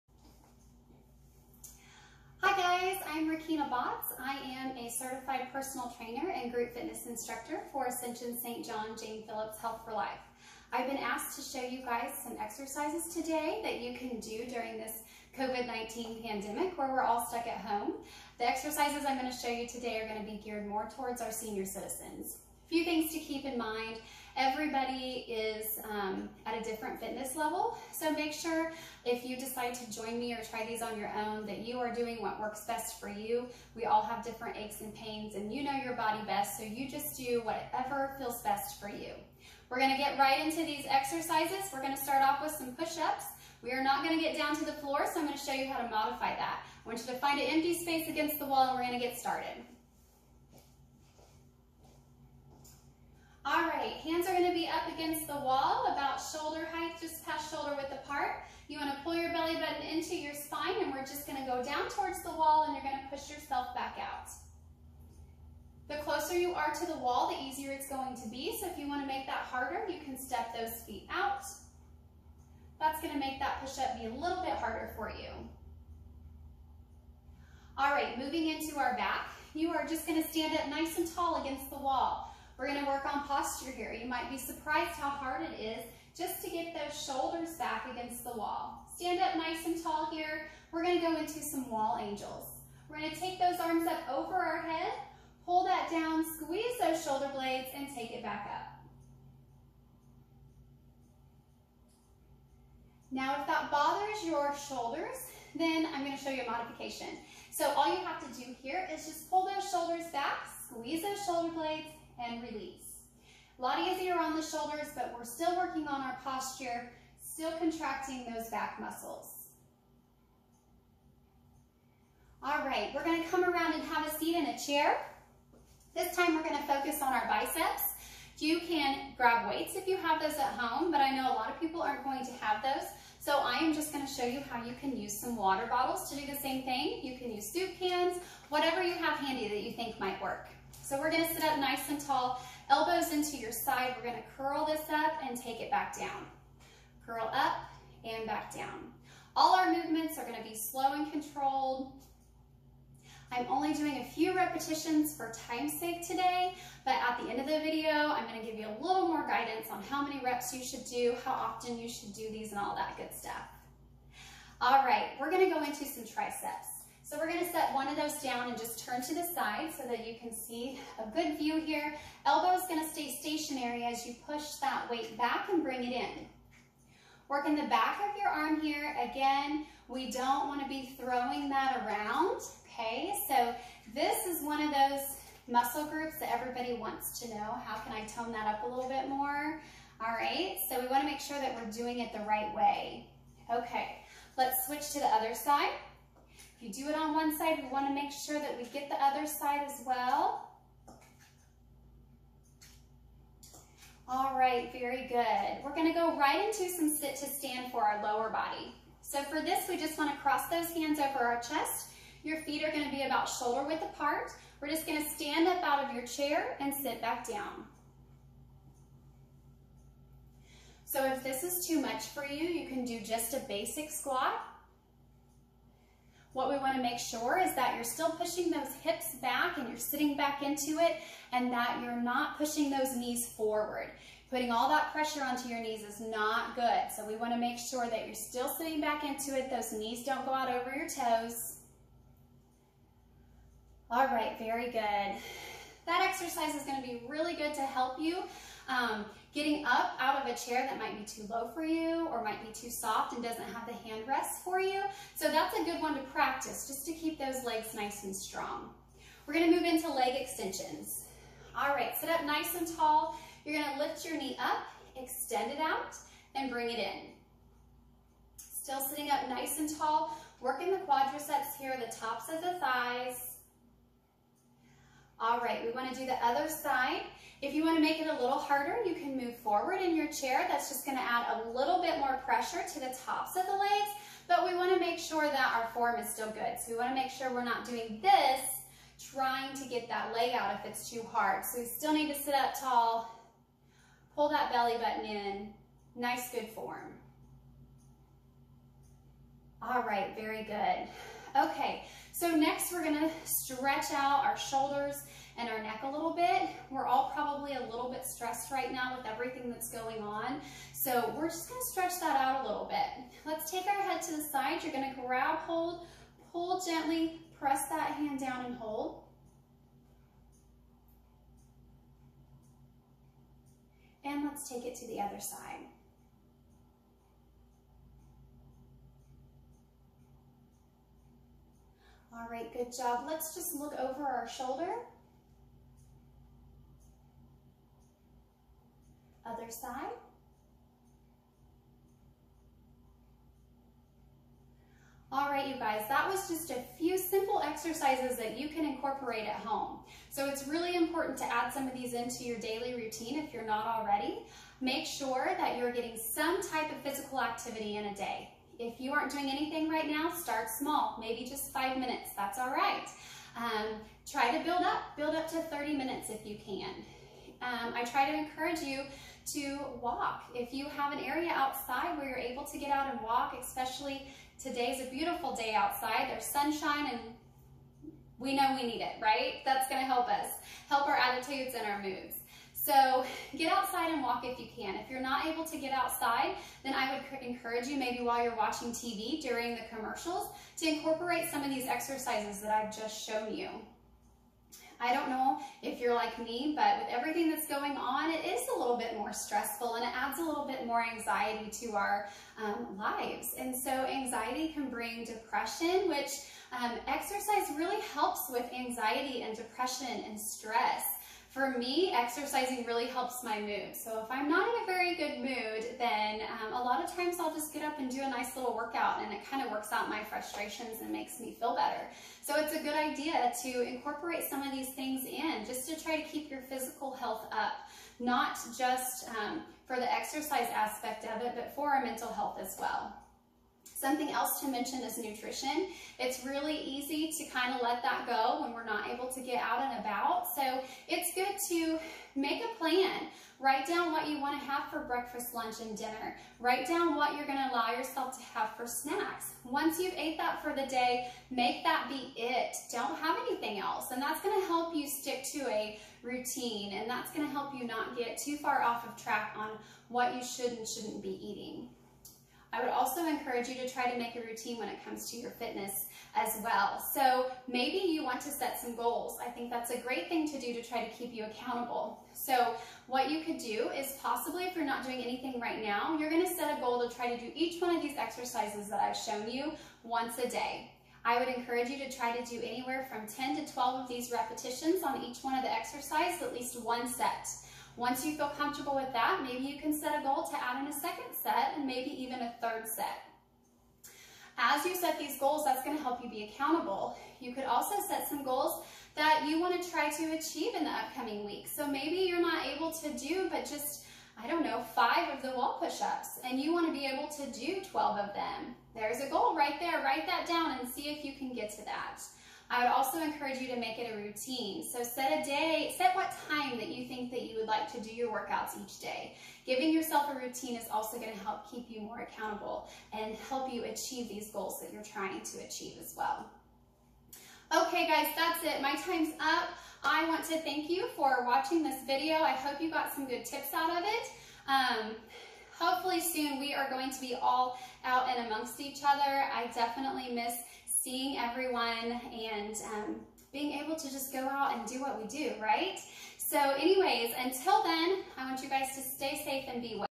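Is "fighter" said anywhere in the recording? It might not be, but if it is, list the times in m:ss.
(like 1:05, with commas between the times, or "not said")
not said.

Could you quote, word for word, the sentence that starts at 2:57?
Working the back of your arm here.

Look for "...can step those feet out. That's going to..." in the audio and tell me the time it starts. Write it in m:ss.
1:10.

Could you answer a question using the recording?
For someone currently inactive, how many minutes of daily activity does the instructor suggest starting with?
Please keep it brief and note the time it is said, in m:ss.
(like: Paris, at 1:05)
5, at 6:01.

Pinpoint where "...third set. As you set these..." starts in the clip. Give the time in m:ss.
8:12.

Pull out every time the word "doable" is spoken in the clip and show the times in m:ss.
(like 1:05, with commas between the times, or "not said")
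not said.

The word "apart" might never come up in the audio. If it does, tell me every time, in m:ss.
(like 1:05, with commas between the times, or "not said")
0:57, 3:33.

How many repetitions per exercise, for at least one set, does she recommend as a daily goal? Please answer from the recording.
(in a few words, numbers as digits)
10 to 12.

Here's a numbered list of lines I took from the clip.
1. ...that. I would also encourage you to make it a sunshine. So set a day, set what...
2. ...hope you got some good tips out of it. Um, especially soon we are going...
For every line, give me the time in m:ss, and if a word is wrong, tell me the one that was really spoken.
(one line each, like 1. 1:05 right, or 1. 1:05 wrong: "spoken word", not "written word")
1. 8:31 wrong: "routine", not "sunshine"
2. 8:52 wrong: "hopefully", not "especially".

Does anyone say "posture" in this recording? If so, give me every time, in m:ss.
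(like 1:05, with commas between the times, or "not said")
1:23, 1:56.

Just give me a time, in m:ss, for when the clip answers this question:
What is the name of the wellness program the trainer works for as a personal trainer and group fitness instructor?
0:09.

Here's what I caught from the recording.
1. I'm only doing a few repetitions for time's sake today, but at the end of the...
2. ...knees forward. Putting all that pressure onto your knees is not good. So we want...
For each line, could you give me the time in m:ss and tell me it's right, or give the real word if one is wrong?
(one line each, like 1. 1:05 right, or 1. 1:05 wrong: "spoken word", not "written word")
1. 2:33 right
2. 3:52 right.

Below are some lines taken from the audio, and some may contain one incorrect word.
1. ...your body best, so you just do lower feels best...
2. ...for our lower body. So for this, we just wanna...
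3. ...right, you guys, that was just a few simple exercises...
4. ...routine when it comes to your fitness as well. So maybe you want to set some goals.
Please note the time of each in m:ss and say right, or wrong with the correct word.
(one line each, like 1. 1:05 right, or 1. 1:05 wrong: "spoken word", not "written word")
1. 0:35 wrong: "whatever", not "lower"
2. 3:27 right
3. 5:45 right
4. 7:44 right.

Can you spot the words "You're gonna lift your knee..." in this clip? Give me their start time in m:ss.
4:23.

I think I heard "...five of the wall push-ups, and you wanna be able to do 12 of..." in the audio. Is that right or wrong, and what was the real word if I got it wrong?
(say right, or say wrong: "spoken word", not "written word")
right.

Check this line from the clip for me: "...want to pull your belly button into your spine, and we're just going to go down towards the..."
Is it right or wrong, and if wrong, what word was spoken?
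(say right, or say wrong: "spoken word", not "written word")
right.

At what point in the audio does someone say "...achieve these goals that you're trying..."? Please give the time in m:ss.
8:43.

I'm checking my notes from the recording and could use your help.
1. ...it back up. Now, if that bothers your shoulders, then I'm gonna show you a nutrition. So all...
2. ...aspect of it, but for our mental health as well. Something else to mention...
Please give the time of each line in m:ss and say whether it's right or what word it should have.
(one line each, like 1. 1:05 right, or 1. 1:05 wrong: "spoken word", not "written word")
1. 1:38 wrong: "modification", not "nutrition"
2. 7:10 right.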